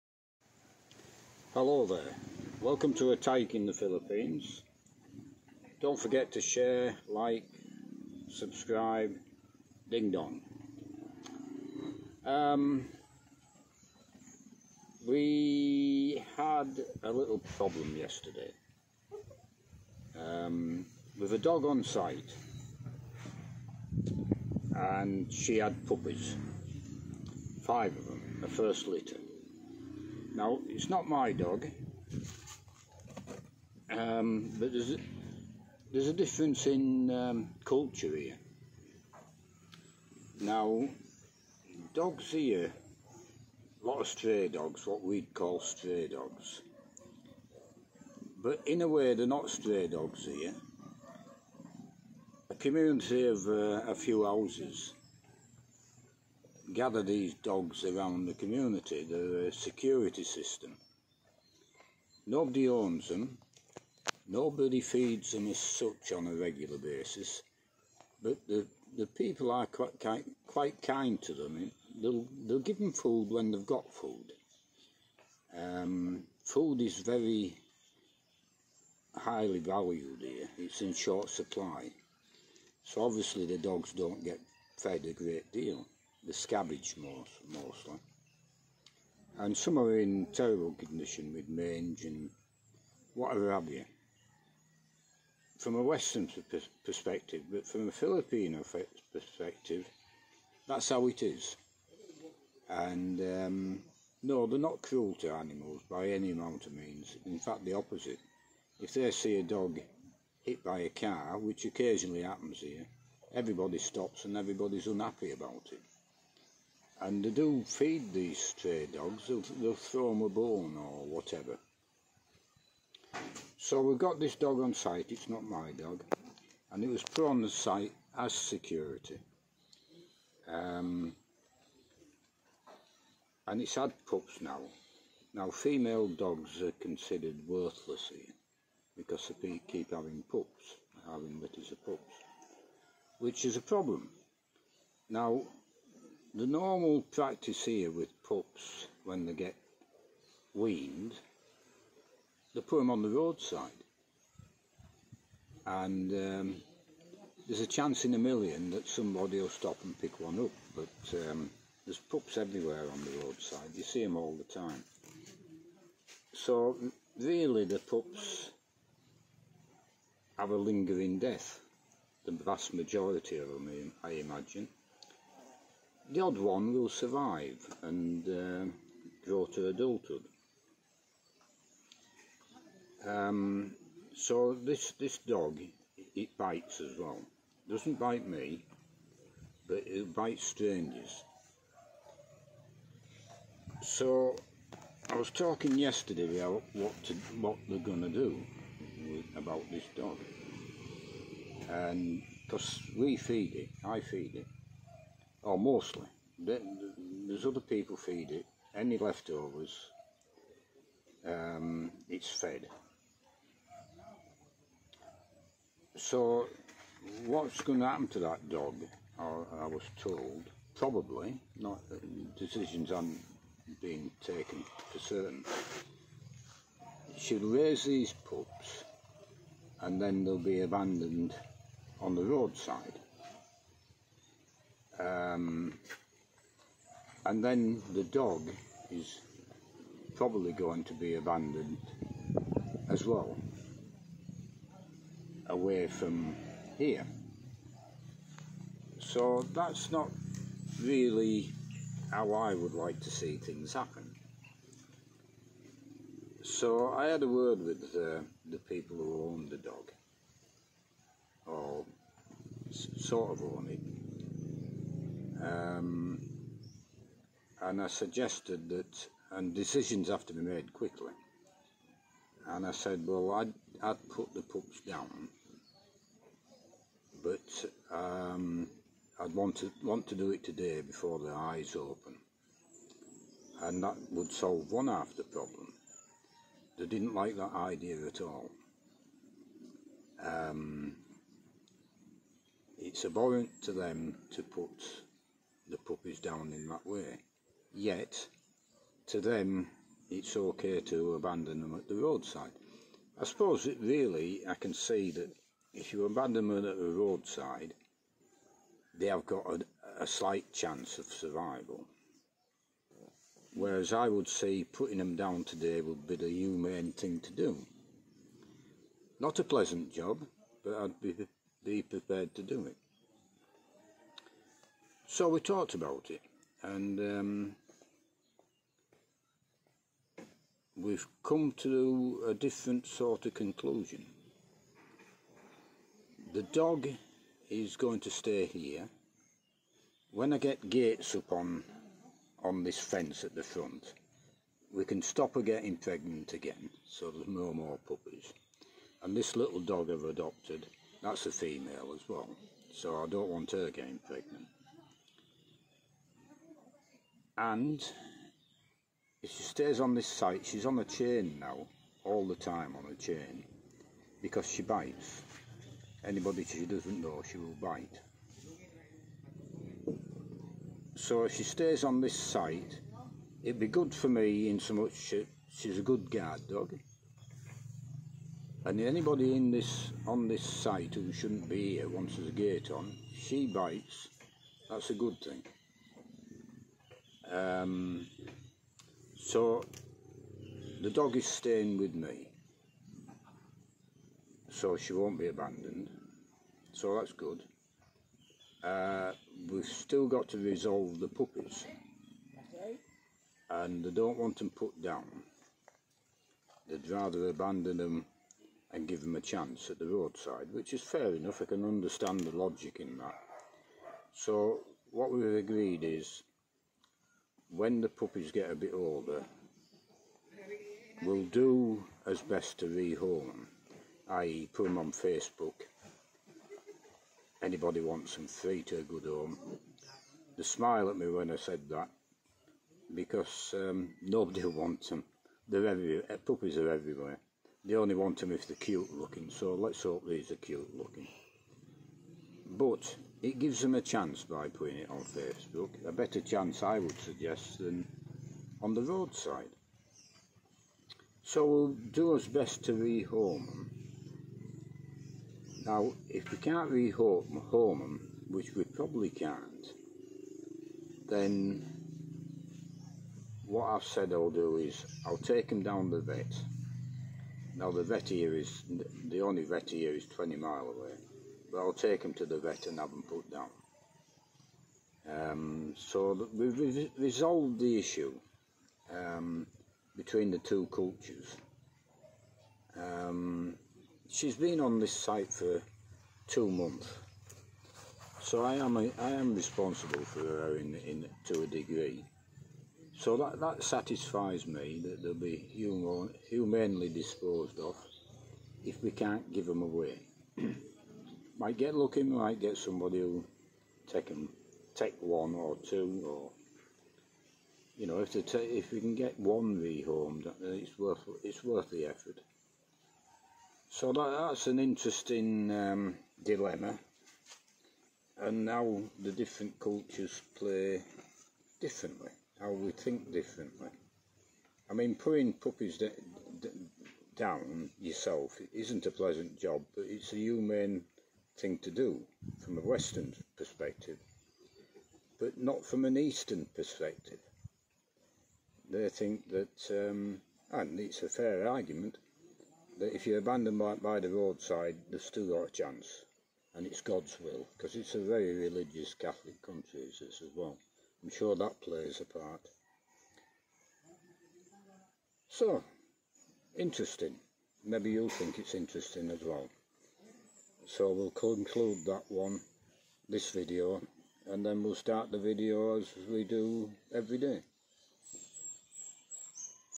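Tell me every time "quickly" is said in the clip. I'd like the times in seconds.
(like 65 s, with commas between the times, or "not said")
270 s.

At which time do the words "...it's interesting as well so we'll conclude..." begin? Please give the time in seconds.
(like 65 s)
558 s.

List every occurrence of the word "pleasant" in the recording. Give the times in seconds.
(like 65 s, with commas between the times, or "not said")
319 s, 528 s.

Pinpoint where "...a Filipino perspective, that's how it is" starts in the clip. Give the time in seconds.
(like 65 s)
97 s.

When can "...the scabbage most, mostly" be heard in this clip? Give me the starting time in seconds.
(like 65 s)
86 s.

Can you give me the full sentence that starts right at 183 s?
Um, so this this dog, it bites as well.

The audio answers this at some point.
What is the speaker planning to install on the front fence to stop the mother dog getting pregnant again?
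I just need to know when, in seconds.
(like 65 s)
340 s.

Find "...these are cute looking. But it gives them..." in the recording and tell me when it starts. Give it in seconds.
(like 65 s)
440 s.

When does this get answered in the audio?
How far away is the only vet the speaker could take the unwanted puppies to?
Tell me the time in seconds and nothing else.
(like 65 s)
470 s.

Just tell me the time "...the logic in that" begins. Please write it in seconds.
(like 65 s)
412 s.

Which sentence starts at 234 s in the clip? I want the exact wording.
Um, and then the dog is probably going to be abandoned as well, away from here.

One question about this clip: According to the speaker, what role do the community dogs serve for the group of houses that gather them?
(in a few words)
security system.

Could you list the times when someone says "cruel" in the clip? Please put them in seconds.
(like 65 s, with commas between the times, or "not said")
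104 s.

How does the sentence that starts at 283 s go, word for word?
And that would solve one half the problem.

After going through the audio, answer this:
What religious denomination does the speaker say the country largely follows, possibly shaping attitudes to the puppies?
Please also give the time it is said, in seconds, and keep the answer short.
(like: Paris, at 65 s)
Catholic, at 548 s.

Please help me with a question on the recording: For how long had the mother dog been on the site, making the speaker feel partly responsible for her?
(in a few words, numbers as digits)
two months.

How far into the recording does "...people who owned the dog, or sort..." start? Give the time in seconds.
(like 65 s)
258 s.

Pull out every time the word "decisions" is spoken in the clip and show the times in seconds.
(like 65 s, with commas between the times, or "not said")
222 s, 269 s.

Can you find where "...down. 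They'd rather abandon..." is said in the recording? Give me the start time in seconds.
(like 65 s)
404 s.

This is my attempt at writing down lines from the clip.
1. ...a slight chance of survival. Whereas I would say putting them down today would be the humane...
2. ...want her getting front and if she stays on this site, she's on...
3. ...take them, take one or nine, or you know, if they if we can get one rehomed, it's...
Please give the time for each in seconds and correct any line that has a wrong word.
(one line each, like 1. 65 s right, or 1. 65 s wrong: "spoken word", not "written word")
1. 310 s right
2. 353 s wrong: "pregnant", not "front"
3. 503 s wrong: "two", not "nine".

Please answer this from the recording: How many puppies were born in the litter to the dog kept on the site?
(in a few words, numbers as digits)
5.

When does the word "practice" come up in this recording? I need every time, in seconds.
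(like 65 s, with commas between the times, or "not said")
147 s.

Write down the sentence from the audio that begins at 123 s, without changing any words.
So we've got this dog on site, it's not my dog, and it was put on the site as security.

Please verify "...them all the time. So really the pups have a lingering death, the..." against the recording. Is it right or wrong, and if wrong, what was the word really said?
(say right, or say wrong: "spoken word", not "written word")
right.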